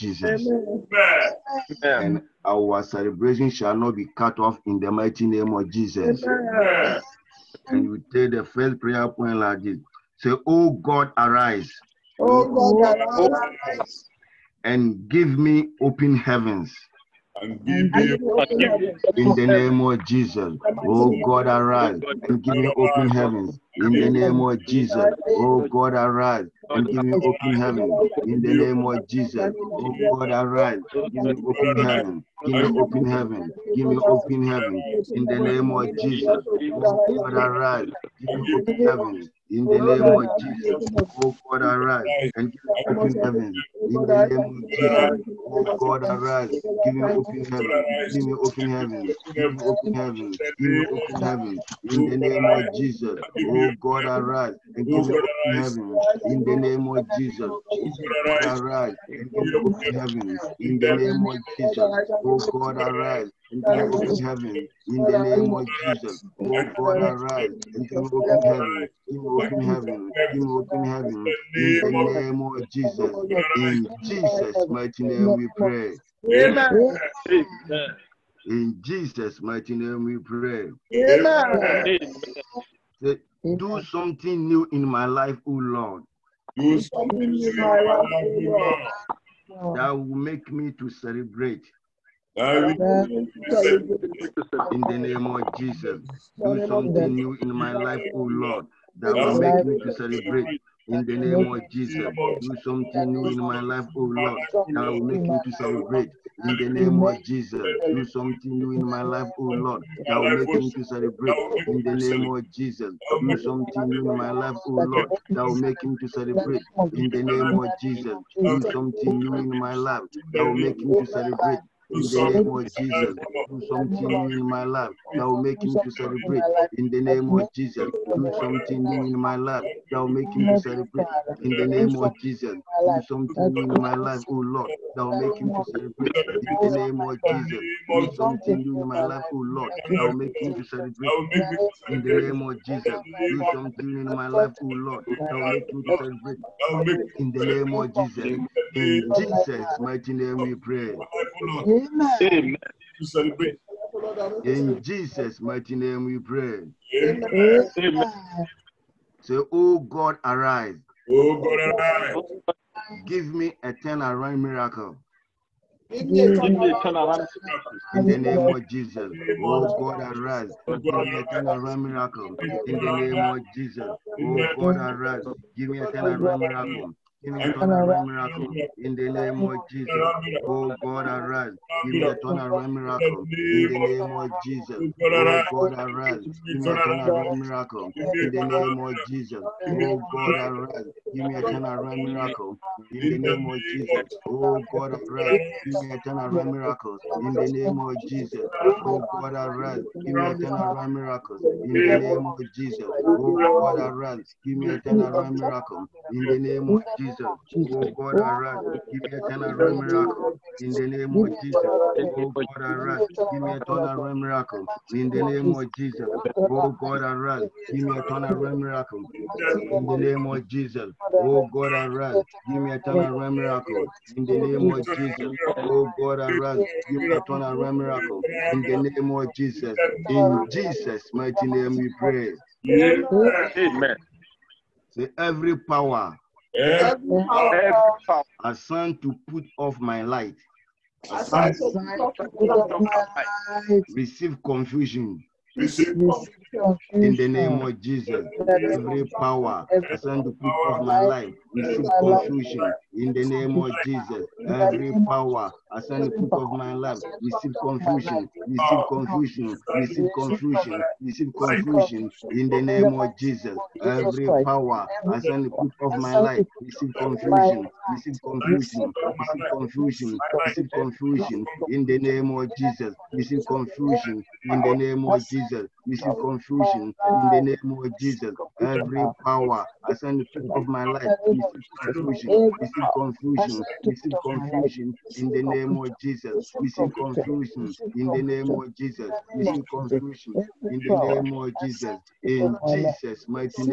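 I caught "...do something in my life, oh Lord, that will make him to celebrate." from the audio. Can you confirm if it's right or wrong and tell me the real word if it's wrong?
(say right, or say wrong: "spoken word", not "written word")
right.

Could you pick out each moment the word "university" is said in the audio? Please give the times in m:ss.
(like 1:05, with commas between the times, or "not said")
not said.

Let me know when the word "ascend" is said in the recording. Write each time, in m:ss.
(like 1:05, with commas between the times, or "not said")
4:39.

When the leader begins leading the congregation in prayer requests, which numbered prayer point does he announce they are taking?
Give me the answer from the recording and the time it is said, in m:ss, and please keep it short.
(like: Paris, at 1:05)
first, at 0:08.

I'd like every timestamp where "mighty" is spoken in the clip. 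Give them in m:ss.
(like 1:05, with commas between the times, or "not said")
0:04, 1:14, 1:19, 2:29, 2:35, 3:51.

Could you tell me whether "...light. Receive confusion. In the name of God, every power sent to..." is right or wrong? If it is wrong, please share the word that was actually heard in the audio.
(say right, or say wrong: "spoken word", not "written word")
wrong: "Jesus", not "God".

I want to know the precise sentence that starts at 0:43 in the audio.
Oh, In the name of Jesus, oh God, arise.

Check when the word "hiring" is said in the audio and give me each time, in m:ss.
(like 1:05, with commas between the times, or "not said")
not said.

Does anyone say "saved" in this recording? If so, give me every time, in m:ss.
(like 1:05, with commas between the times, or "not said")
not said.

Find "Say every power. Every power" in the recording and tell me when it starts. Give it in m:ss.
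3:54.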